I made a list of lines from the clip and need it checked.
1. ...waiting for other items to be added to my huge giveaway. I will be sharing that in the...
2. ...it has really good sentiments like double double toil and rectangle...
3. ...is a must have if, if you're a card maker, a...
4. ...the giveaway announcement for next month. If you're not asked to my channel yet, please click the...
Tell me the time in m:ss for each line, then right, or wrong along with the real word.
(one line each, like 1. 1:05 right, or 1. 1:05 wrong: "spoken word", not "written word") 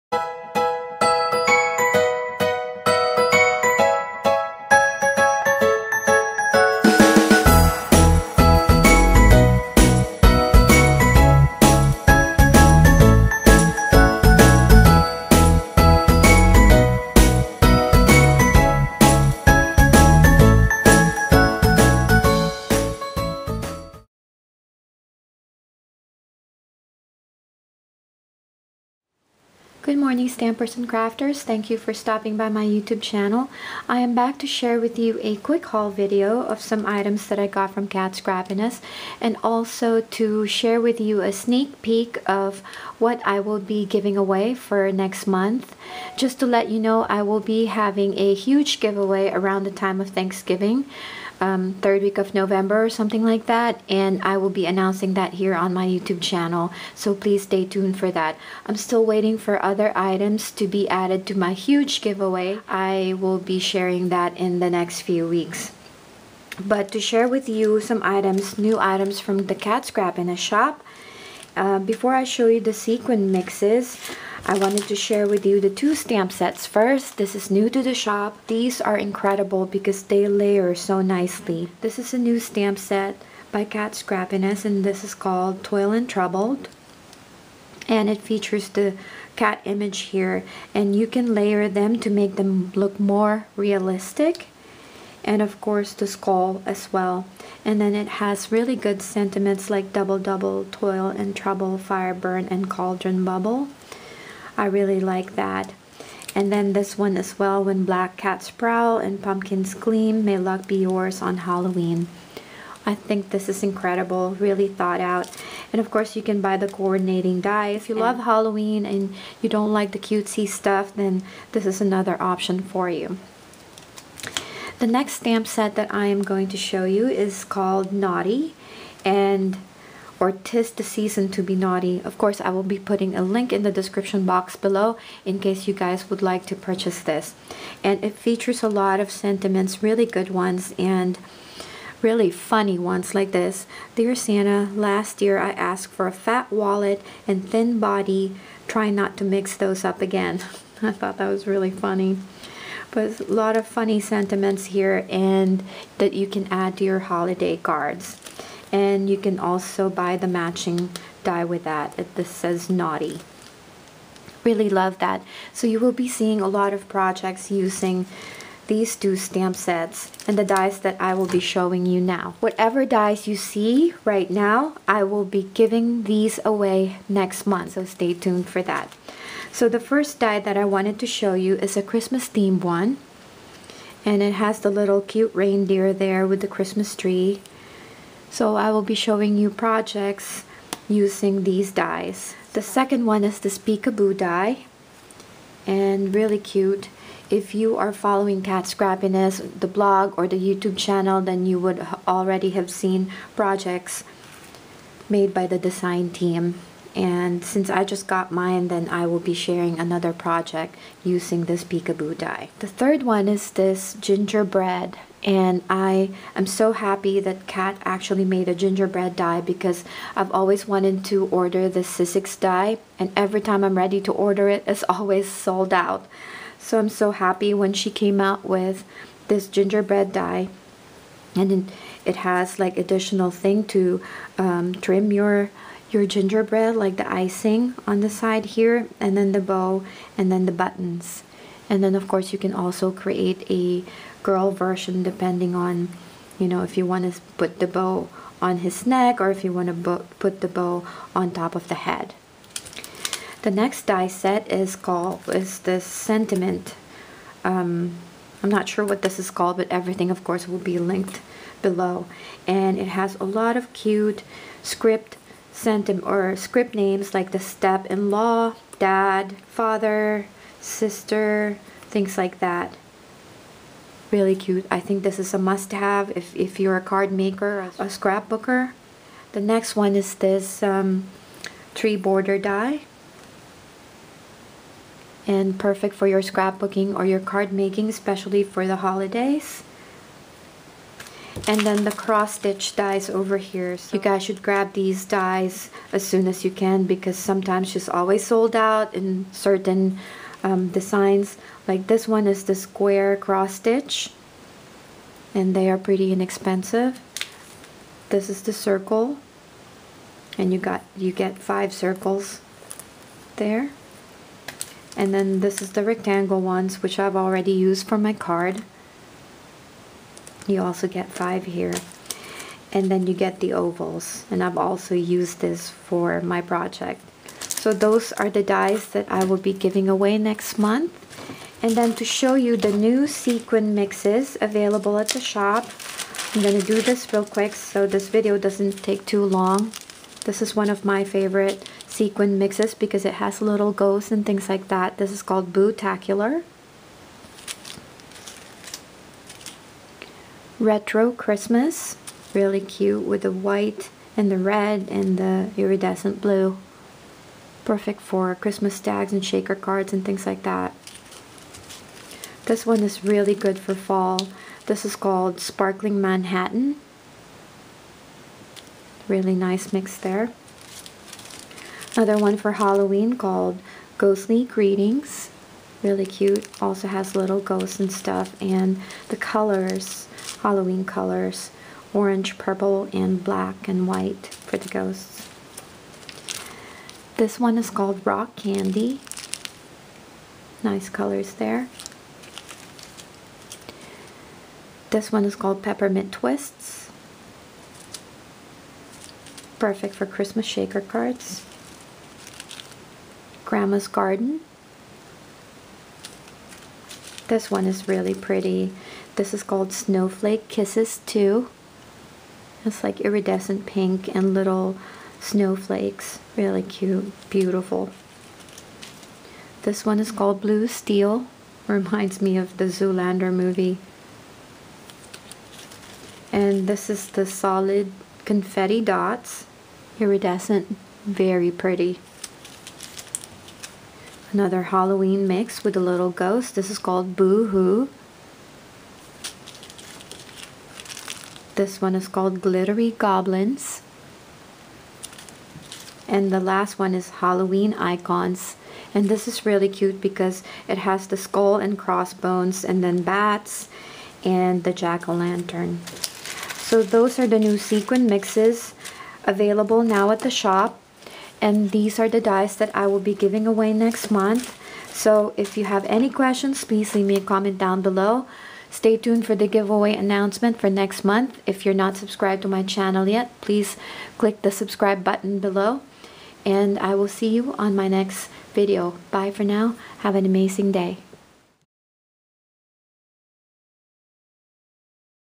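1. 0:59 right
2. 1:37 wrong: "trouble", not "rectangle"
3. 4:35 right
4. 7:49 wrong: "subscribed", not "asked".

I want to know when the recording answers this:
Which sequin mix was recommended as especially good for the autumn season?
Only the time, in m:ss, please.
6:05.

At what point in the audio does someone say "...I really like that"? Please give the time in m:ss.
1:44.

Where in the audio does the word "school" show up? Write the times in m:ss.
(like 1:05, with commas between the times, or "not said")
not said.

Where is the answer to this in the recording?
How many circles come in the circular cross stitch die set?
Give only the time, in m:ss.
5:11.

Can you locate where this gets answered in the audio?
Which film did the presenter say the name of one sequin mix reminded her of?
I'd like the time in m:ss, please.
7:02.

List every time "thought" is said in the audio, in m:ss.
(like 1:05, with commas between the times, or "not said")
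1:54, 2:30.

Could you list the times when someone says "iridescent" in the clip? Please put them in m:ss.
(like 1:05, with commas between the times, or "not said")
5:55, 6:52, 7:10.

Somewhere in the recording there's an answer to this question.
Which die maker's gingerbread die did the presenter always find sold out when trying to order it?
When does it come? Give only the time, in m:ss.
3:41.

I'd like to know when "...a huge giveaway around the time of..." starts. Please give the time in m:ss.
0:48.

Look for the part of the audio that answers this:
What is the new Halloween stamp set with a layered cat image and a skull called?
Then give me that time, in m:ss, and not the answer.
1:25.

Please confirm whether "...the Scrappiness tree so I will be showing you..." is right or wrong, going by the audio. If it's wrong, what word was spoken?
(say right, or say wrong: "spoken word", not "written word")
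wrong: "Christmas", not "Scrappiness".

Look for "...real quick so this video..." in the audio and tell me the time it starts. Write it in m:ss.
5:37.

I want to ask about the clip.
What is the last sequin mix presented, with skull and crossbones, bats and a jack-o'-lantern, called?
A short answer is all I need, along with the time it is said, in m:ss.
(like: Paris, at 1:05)
Halloween Icons, at 7:27.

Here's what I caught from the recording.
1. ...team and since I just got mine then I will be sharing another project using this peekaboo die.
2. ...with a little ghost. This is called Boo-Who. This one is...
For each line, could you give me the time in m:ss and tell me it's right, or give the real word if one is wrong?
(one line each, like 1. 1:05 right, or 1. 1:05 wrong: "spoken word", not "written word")
1. 3:26 right
2. 7:15 right.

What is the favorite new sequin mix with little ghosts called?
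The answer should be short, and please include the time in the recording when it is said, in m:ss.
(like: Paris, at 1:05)
Bootacular, at 5:45.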